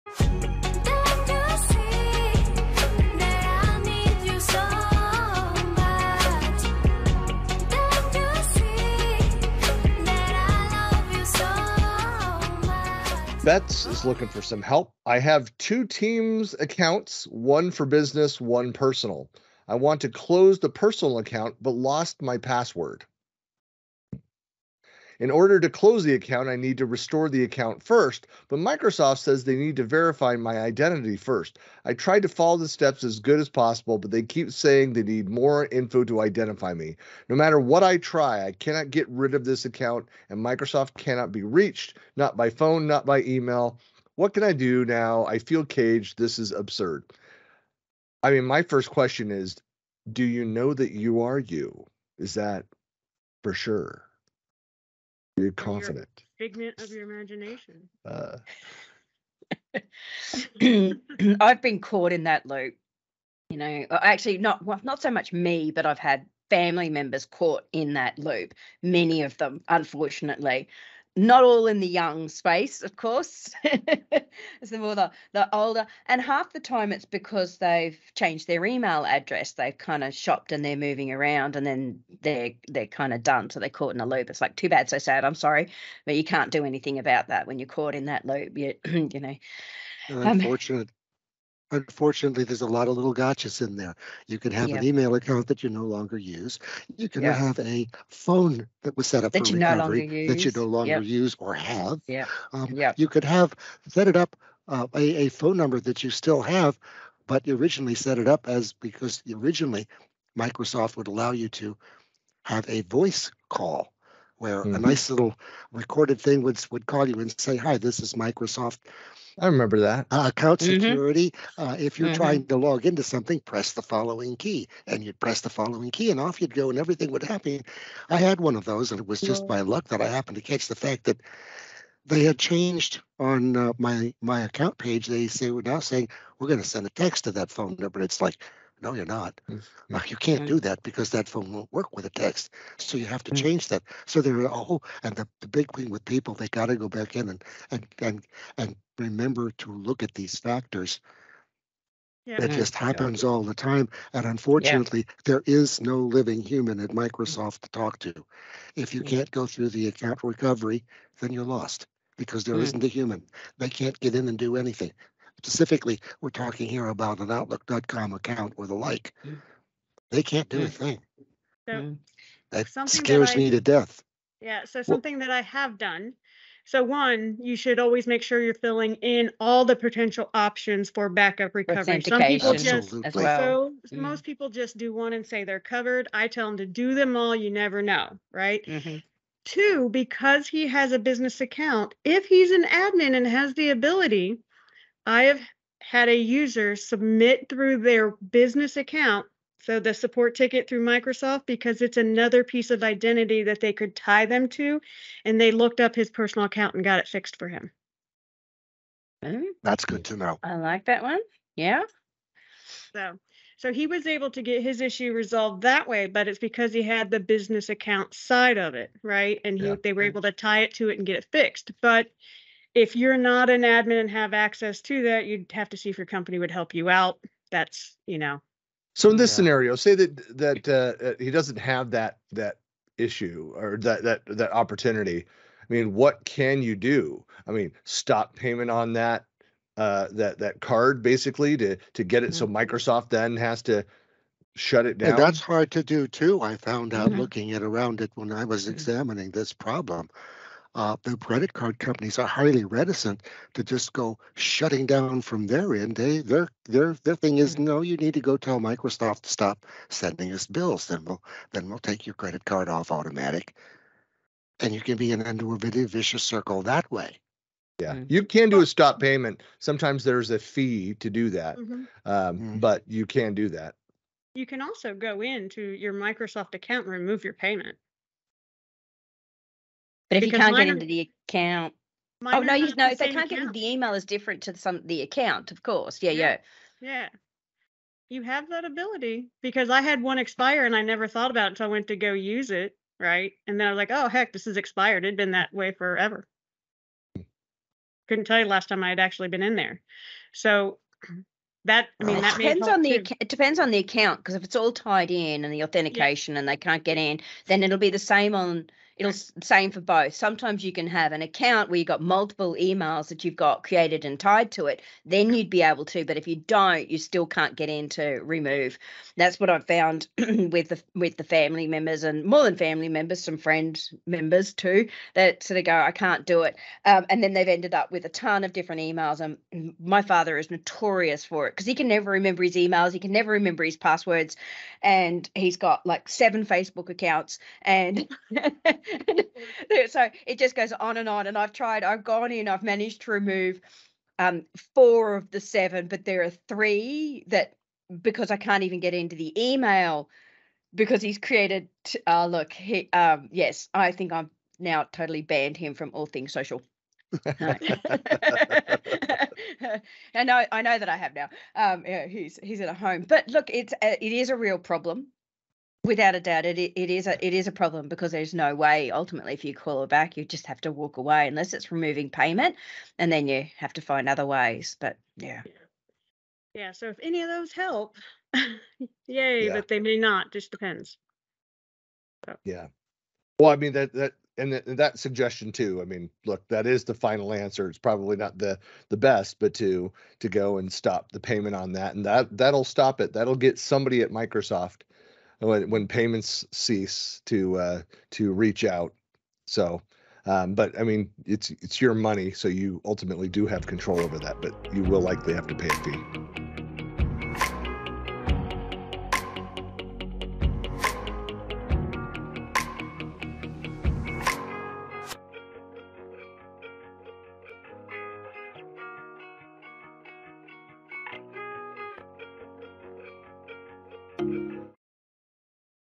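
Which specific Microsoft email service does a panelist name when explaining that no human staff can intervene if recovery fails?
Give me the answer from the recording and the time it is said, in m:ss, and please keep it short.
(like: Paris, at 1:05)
Outlook.com, at 2:47.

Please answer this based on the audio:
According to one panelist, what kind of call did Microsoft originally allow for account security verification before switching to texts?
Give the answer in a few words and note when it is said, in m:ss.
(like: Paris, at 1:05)
Voice call, at 1:52.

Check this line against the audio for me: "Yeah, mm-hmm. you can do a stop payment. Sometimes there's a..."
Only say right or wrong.
right.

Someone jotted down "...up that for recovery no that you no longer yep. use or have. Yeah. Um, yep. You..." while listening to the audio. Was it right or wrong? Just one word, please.
right.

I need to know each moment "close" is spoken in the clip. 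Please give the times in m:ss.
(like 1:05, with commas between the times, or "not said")
0:20, 0:25.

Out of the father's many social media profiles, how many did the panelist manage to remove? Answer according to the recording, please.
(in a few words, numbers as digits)
4.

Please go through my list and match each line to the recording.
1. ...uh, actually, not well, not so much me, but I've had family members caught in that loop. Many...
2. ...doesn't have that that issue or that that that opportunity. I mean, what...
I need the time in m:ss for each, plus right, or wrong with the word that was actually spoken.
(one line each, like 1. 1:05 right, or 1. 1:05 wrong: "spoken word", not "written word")
1. 1:03 right
2. 3:51 right.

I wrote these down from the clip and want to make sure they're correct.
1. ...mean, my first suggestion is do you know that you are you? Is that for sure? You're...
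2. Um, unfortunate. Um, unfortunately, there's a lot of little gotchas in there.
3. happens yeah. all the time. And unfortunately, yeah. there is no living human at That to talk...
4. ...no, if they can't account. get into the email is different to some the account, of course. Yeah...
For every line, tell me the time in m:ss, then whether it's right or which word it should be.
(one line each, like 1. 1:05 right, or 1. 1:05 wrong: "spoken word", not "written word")
1. 0:48 wrong: "question", not "suggestion"
2. 1:30 right
3. 2:32 wrong: "Microsoft", not "That"
4. 4:42 right.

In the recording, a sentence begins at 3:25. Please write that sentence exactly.
And they looked up his personal account and got it fixed for him.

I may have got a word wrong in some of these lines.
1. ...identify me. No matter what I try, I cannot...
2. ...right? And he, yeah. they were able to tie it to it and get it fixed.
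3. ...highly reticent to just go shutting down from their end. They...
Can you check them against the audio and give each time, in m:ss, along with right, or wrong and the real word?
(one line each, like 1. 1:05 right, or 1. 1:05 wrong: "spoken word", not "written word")
1. 0:36 right
2. 3:39 right
3. 4:12 right.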